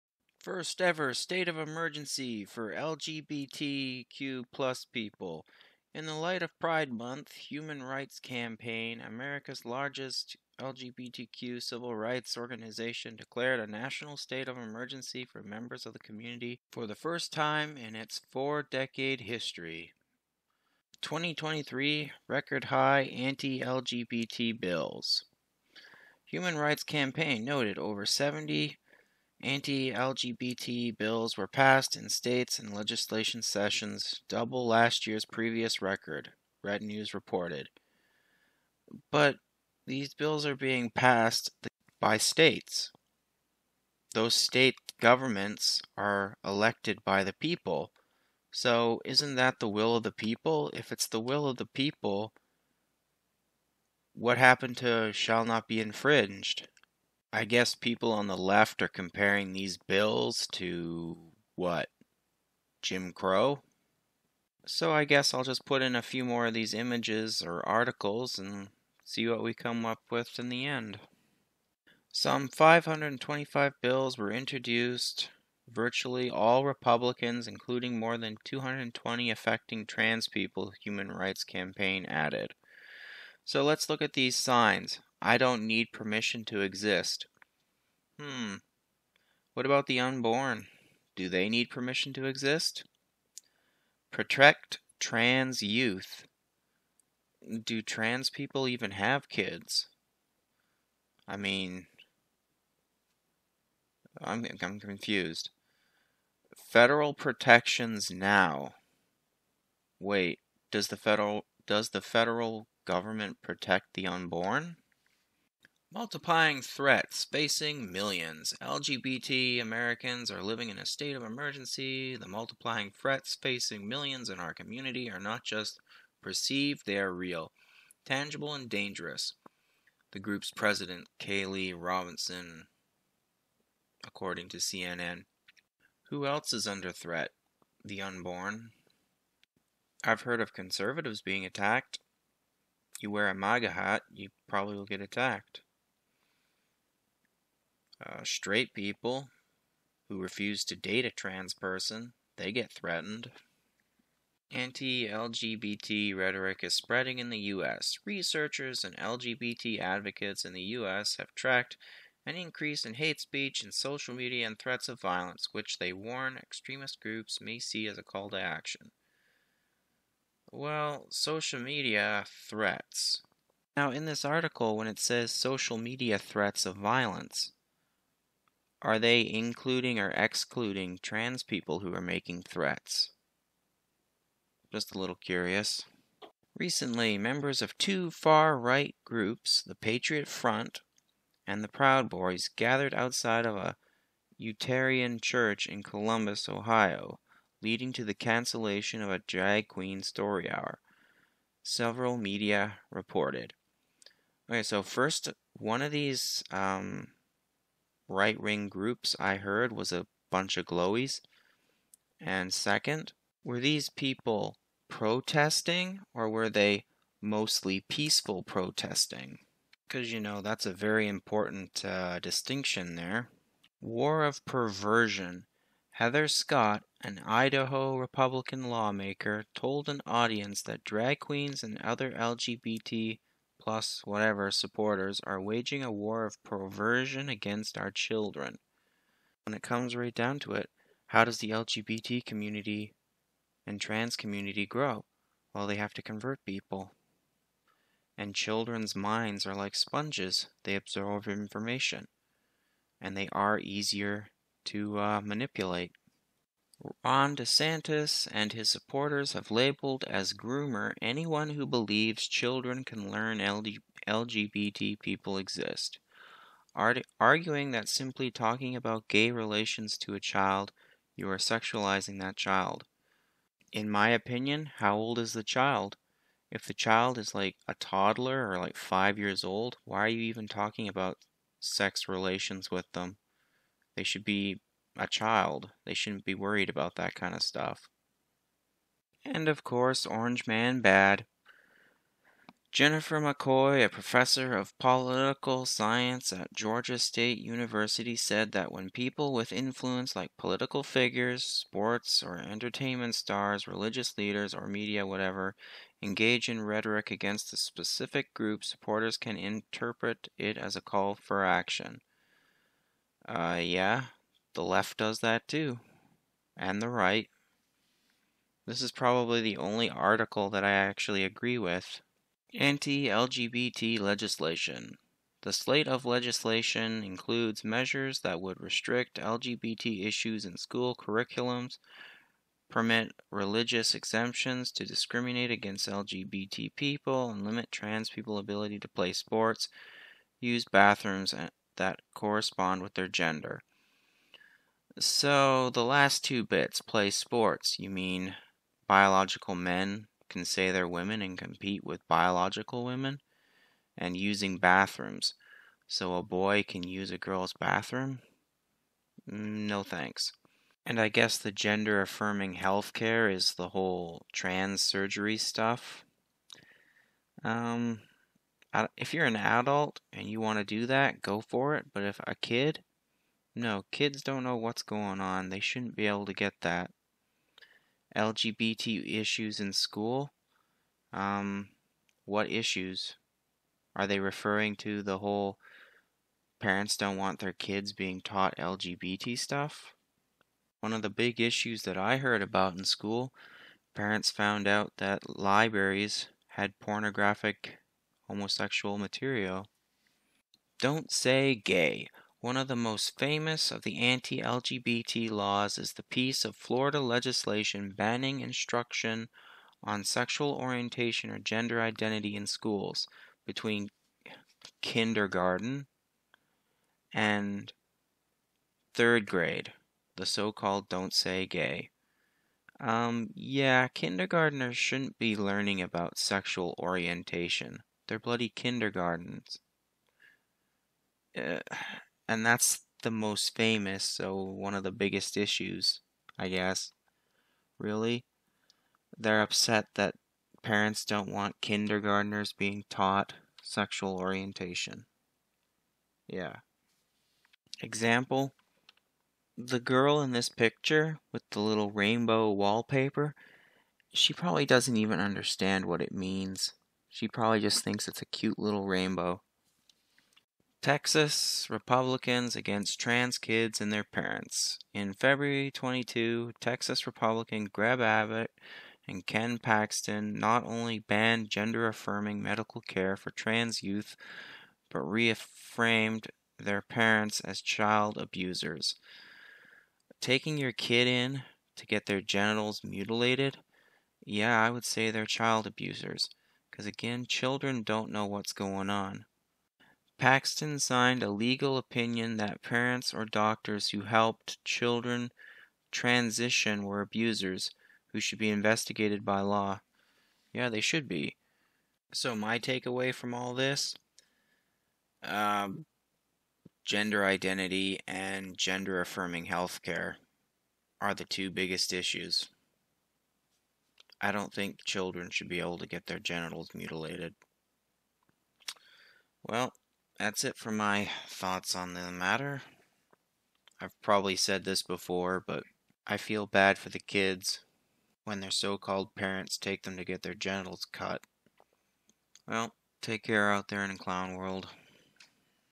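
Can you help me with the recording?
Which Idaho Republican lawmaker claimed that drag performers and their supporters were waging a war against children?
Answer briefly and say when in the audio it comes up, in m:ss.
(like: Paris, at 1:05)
Heather Scott, at 3:45.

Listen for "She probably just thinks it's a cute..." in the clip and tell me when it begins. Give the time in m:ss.
7:37.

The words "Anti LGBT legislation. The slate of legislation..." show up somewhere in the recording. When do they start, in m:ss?
5:22.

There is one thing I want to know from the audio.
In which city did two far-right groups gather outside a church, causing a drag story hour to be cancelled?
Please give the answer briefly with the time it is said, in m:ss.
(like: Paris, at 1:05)
Columbus, Ohio, at 3:15.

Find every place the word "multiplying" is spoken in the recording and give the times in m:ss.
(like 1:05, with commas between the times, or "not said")
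1:55, 2:02.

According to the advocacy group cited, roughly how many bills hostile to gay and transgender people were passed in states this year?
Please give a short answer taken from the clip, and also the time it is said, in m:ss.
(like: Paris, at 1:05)
over 70, at 0:27.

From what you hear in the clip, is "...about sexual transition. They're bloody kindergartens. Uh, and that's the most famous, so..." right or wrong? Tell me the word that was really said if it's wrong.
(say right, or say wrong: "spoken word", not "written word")
wrong: "orientation", not "transition".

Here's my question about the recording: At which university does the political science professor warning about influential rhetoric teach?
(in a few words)
Georgia State University.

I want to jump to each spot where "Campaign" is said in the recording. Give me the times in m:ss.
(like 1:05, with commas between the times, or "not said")
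0:08, 0:26, 1:21.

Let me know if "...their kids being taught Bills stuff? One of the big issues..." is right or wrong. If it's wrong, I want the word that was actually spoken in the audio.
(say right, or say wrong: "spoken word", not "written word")
wrong: "LGBT", not "Bills".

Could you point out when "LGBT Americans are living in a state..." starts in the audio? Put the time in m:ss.
1:58.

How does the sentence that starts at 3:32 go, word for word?
And second, were these people protesting or were they mostly peaceful protesting?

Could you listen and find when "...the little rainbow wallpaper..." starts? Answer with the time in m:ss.
7:31.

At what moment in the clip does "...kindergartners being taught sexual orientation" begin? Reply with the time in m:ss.
7:21.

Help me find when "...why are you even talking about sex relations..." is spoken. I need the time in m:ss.
4:39.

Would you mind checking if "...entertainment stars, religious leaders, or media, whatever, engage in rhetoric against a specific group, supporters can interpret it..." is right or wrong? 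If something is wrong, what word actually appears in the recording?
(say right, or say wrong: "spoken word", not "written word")
right.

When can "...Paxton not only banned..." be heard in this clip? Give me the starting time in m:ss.
7:49.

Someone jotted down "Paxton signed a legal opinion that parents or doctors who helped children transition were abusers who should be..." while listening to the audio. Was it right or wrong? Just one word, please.
right.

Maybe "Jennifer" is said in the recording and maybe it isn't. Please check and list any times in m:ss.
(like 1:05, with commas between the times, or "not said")
4:52.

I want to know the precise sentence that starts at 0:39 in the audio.
But these bills are being passed by states.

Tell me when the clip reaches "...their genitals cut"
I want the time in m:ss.
8:50.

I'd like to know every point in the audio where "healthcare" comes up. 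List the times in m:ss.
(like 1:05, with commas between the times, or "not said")
6:02, 8:29.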